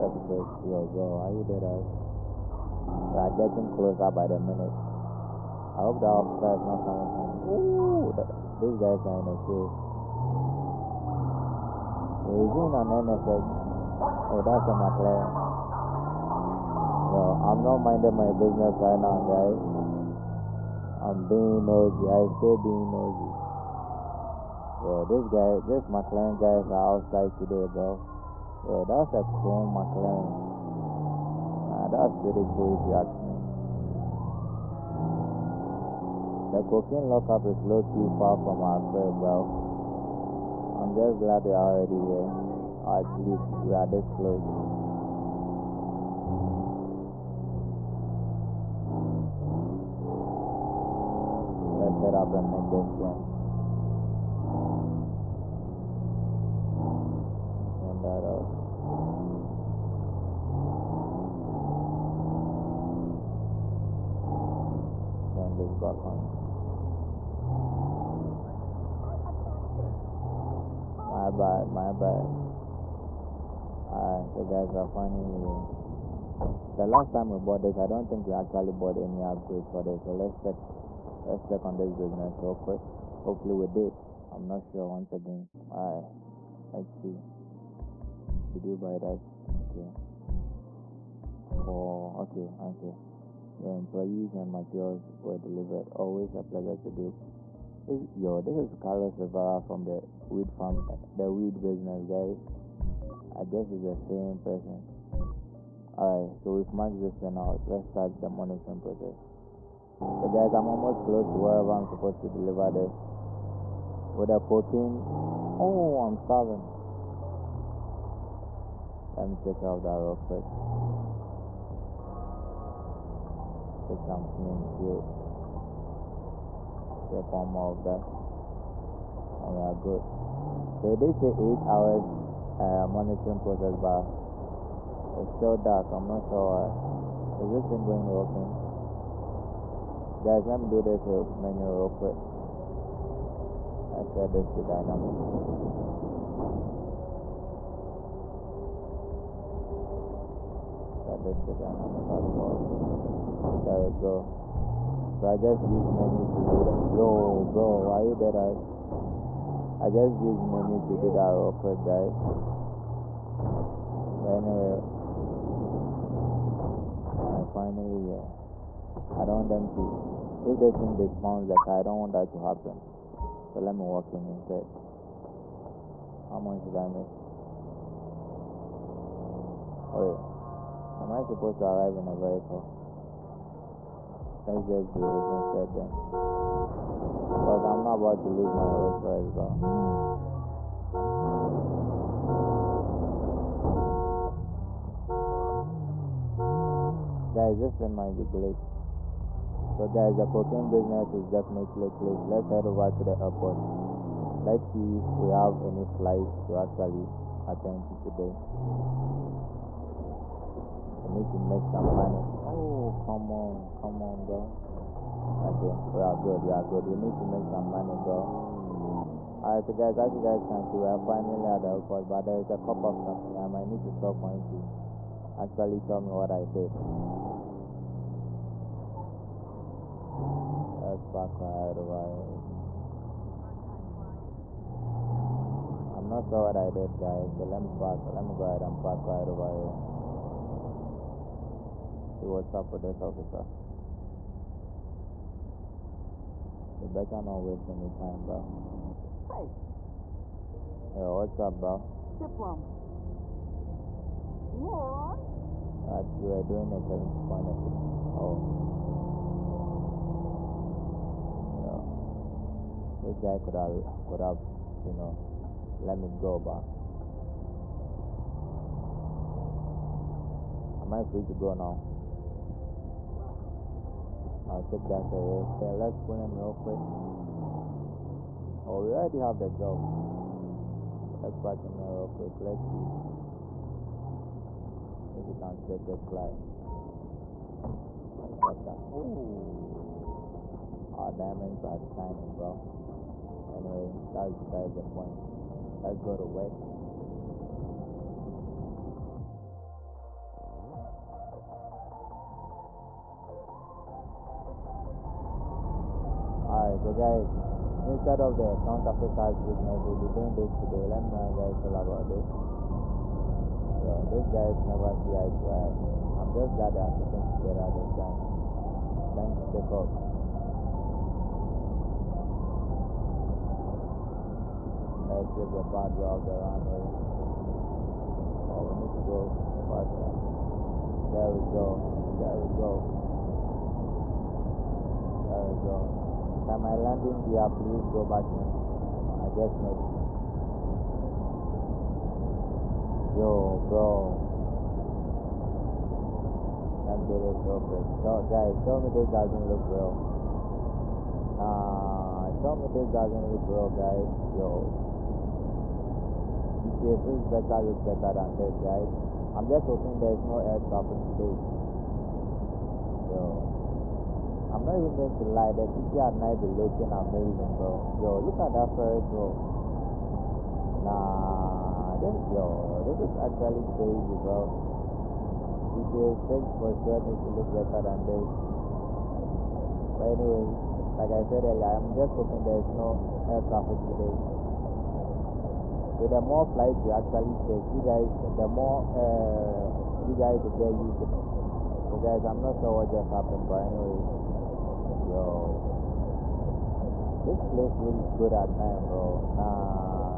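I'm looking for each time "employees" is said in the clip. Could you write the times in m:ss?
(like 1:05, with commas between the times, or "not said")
1:33.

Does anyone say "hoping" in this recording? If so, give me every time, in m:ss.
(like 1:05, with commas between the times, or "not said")
5:59, 6:22.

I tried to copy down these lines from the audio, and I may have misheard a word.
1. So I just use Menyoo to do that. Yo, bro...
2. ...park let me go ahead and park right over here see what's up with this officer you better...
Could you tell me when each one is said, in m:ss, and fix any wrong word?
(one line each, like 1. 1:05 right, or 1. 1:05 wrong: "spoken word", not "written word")
1. 2:35 right
2. 3:57 right.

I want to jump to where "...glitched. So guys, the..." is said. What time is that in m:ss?
3:18.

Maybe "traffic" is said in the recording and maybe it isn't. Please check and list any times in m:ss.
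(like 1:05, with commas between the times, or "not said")
6:00, 6:23.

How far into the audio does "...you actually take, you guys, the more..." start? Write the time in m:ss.
6:26.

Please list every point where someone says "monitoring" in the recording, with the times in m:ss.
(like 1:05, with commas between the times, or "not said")
1:48, 2:12.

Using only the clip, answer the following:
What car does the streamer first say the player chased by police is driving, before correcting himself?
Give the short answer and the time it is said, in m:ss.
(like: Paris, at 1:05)
NSX, at 0:13.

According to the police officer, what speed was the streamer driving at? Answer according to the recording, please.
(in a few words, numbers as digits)
74.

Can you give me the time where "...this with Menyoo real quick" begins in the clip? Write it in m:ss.
2:20.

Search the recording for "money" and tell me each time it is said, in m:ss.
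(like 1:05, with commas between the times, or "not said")
3:31, 3:37.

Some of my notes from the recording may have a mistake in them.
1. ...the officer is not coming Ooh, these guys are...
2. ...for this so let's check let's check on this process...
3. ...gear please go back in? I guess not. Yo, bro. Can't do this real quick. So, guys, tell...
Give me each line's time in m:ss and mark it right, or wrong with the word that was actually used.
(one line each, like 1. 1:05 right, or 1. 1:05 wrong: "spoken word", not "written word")
1. 0:05 right
2. 1:19 wrong: "business", not "process"
3. 5:37 right.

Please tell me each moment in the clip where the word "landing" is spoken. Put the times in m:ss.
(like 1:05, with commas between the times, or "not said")
5:36.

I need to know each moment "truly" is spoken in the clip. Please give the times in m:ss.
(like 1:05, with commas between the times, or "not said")
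not said.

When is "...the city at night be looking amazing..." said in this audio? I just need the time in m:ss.
6:05.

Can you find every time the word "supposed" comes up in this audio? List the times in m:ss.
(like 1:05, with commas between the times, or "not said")
1:51, 3:01.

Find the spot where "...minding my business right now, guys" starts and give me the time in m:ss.
0:17.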